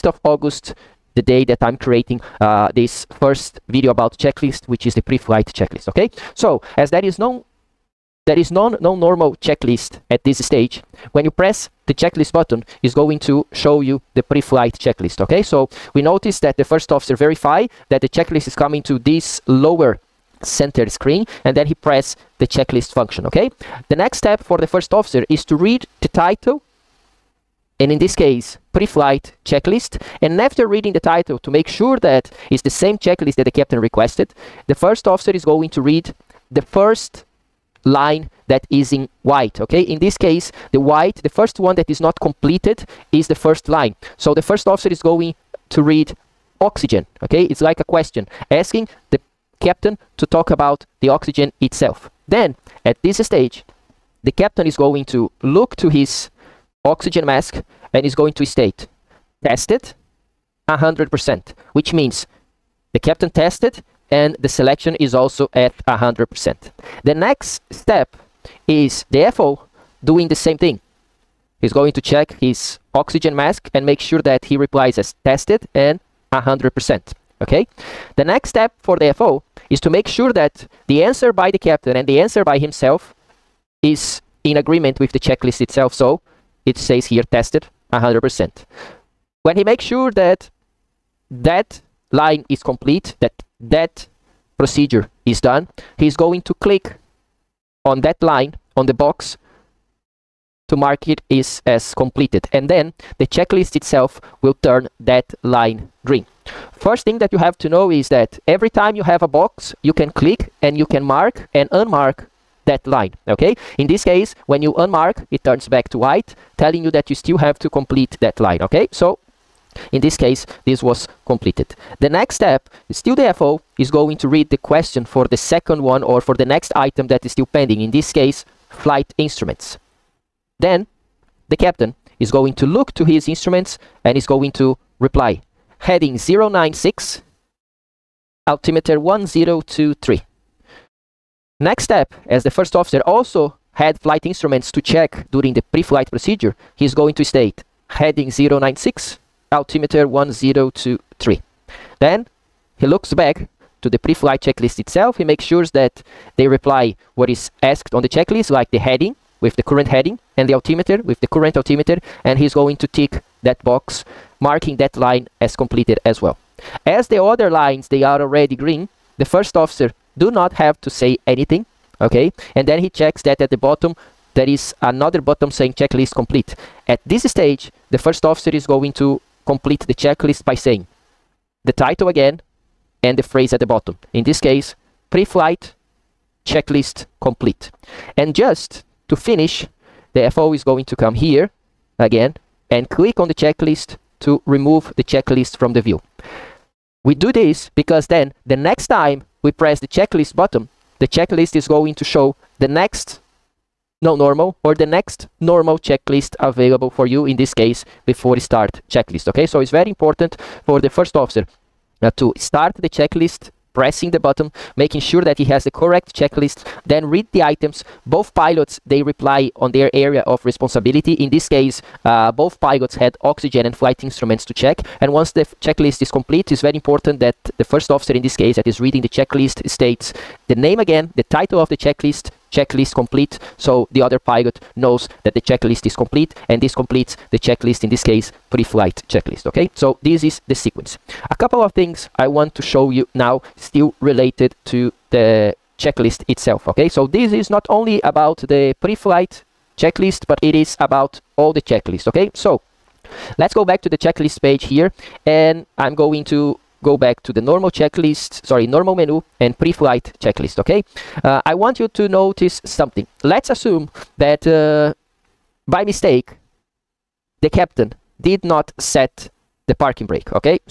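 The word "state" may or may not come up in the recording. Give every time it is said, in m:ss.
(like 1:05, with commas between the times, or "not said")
0:58, 2:27, 3:49.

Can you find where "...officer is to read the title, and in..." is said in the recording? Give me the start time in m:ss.
0:24.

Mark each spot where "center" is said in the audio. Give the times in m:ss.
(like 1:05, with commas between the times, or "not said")
0:20.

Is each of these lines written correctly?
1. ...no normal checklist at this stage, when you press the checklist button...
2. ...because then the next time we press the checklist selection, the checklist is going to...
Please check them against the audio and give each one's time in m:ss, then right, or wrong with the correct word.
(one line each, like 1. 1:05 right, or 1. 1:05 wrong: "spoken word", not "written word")
1. 0:08 right
2. 3:17 wrong: "button", not "selection".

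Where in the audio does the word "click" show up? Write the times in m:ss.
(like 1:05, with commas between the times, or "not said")
1:36, 1:50, 3:12.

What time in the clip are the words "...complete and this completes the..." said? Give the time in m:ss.
3:55.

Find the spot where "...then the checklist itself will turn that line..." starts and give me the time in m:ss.
1:42.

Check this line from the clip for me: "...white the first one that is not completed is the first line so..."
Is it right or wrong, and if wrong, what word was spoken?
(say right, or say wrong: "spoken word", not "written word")
right.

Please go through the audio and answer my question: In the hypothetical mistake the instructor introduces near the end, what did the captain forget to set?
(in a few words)
Parking brake.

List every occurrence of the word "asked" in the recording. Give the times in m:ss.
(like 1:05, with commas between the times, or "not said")
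2:37.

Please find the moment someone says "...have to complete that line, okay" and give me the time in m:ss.
1:57.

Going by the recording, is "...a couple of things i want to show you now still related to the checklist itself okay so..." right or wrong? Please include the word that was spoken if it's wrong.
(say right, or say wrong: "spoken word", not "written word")
right.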